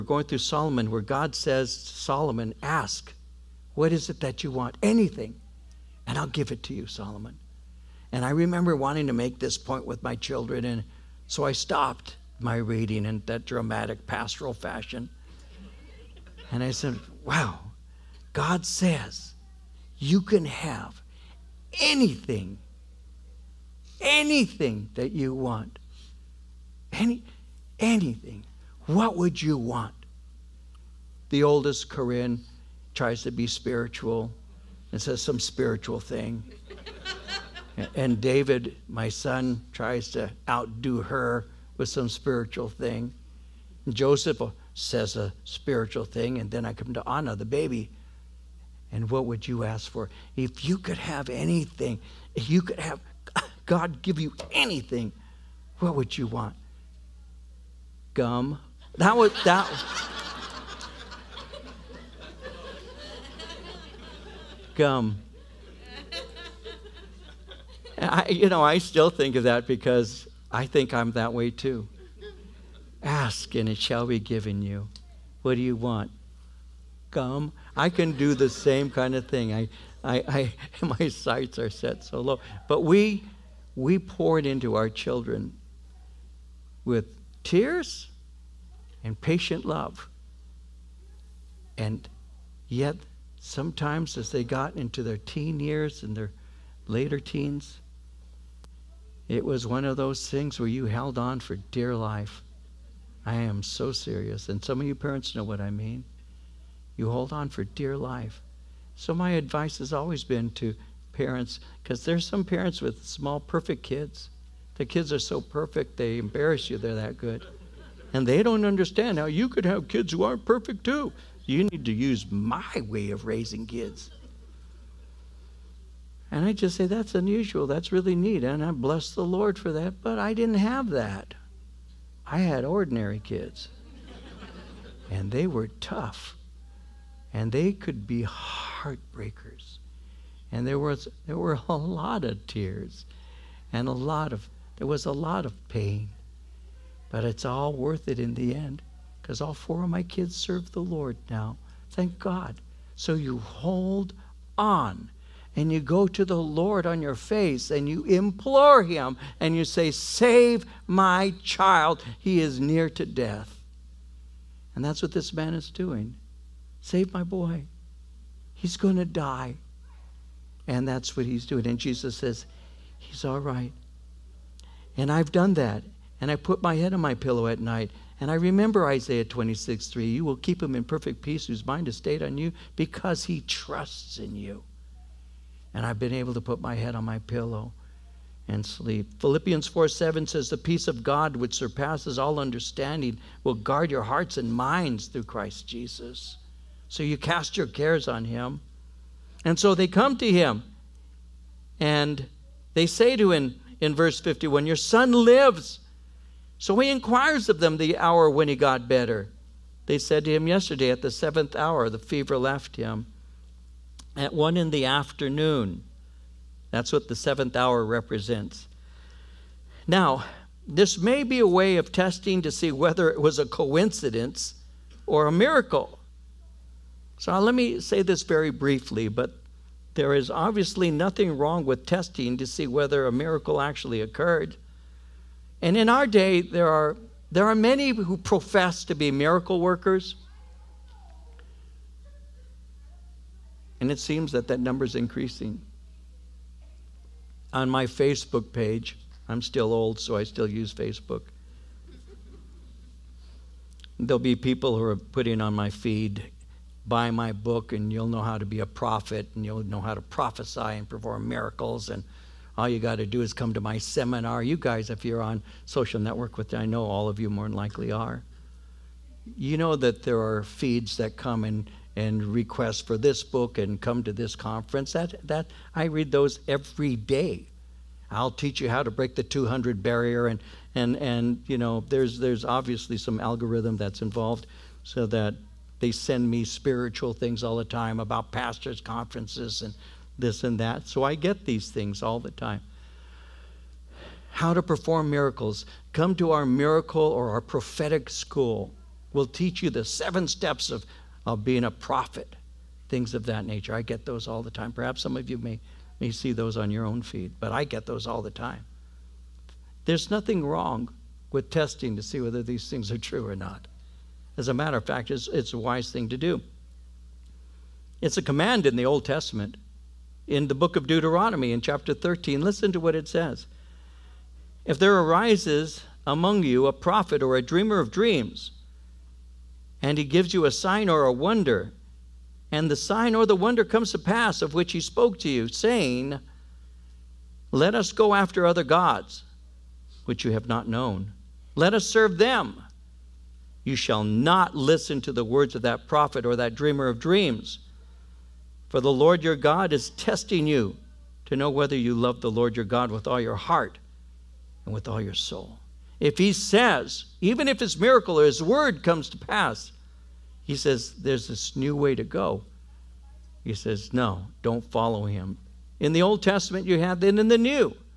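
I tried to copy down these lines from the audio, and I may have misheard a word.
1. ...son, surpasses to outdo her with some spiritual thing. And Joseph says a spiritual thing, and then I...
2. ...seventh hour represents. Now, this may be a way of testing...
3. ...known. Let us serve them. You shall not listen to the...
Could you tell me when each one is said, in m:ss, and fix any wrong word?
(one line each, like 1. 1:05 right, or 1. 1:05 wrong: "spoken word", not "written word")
1. 0:39 wrong: "tries", not "surpasses"
2. 3:37 right
3. 5:40 right.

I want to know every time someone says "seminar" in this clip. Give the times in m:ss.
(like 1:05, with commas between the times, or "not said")
4:23.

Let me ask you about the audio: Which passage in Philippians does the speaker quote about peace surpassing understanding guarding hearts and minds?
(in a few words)
Philippians 4:7.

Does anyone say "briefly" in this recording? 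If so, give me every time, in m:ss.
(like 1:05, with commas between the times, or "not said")
3:48.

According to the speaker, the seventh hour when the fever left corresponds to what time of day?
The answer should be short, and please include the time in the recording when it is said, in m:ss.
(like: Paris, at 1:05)
One in the afternoon, at 3:34.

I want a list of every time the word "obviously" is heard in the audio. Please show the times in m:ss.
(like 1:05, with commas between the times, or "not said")
3:50, 4:42.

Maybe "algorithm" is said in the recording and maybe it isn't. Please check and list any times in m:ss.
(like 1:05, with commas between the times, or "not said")
4:43.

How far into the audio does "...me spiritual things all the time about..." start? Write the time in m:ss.
4:46.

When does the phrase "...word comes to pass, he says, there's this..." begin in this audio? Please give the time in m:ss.
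5:58.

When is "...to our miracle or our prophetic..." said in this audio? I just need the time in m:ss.
4:56.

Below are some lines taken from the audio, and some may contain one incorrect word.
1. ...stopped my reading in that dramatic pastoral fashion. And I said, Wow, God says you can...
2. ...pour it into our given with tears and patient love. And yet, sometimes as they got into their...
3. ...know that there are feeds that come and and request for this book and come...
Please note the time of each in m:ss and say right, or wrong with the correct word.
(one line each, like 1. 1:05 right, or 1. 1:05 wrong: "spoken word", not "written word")
1. 0:11 right
2. 1:23 wrong: "children", not "given"
3. 4:29 right.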